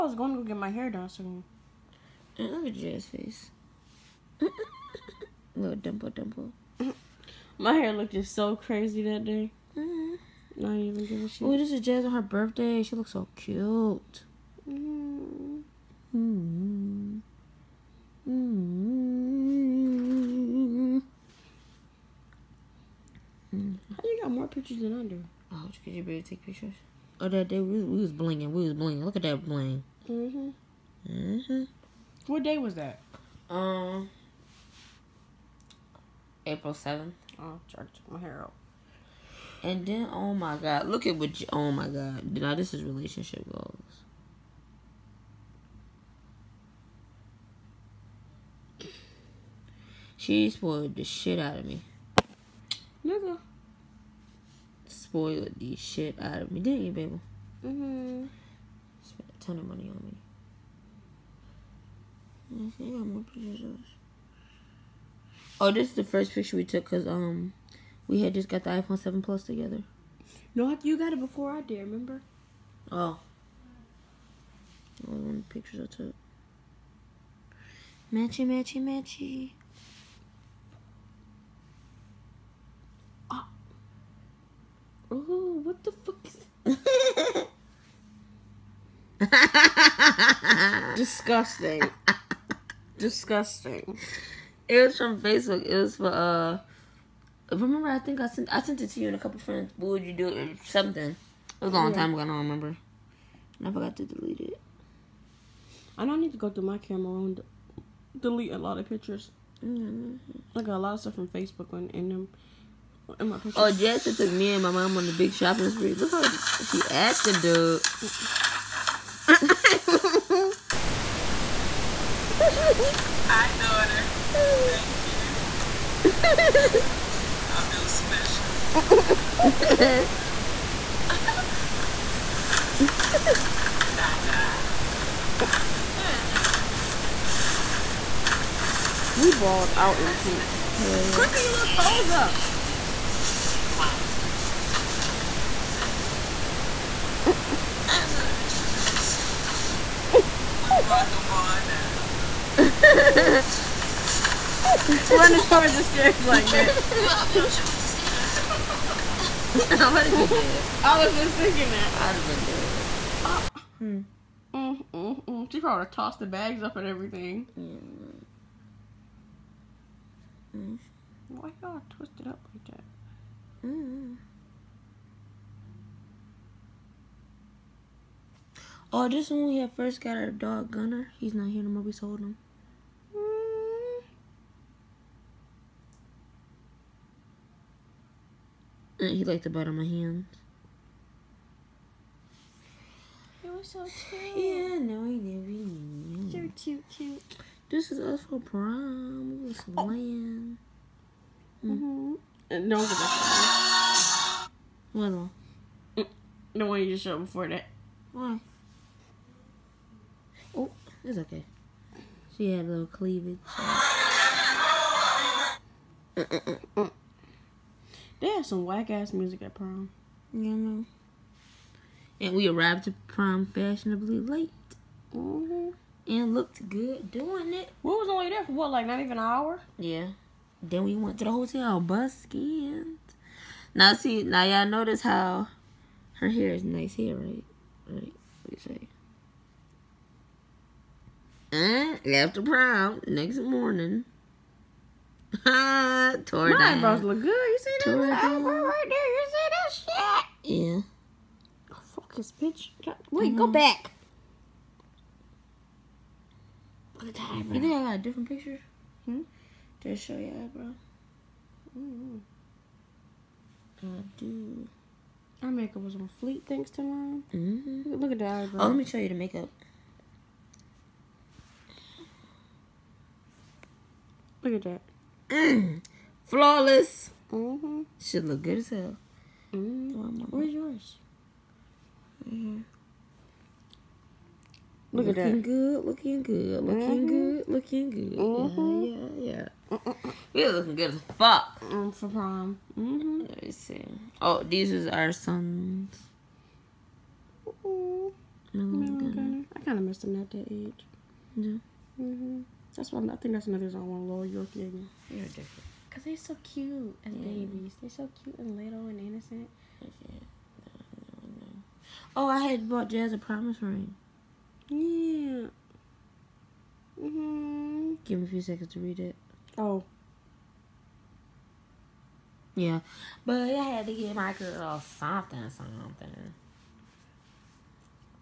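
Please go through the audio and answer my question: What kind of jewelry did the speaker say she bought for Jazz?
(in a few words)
promise ring.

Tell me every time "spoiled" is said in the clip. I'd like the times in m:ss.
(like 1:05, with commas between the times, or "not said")
0:50, 0:54.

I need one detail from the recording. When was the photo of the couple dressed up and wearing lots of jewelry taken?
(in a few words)
April 7.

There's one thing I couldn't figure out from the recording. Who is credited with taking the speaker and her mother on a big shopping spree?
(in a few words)
Jessica.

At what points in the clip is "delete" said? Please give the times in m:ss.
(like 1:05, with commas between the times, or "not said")
1:44, 1:48.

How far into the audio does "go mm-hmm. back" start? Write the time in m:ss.
4:13.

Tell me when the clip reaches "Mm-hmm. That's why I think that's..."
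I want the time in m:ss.
5:02.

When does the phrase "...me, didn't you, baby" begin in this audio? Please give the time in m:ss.
0:56.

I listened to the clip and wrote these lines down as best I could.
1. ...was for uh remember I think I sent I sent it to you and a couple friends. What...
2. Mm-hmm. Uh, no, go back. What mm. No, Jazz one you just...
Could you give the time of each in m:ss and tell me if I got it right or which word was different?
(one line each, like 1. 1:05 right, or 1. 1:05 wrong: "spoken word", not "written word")
1. 1:35 right
2. 3:21 wrong: "The", not "Jazz".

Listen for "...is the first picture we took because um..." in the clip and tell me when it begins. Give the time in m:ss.
1:05.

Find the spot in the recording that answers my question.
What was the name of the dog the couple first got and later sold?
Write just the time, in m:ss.
3:00.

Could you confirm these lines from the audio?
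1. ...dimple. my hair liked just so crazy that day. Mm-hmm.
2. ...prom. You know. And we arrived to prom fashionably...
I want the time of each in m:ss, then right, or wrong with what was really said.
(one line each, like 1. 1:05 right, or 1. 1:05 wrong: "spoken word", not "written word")
1. 0:06 wrong: "looked", not "liked"
2. 3:39 right.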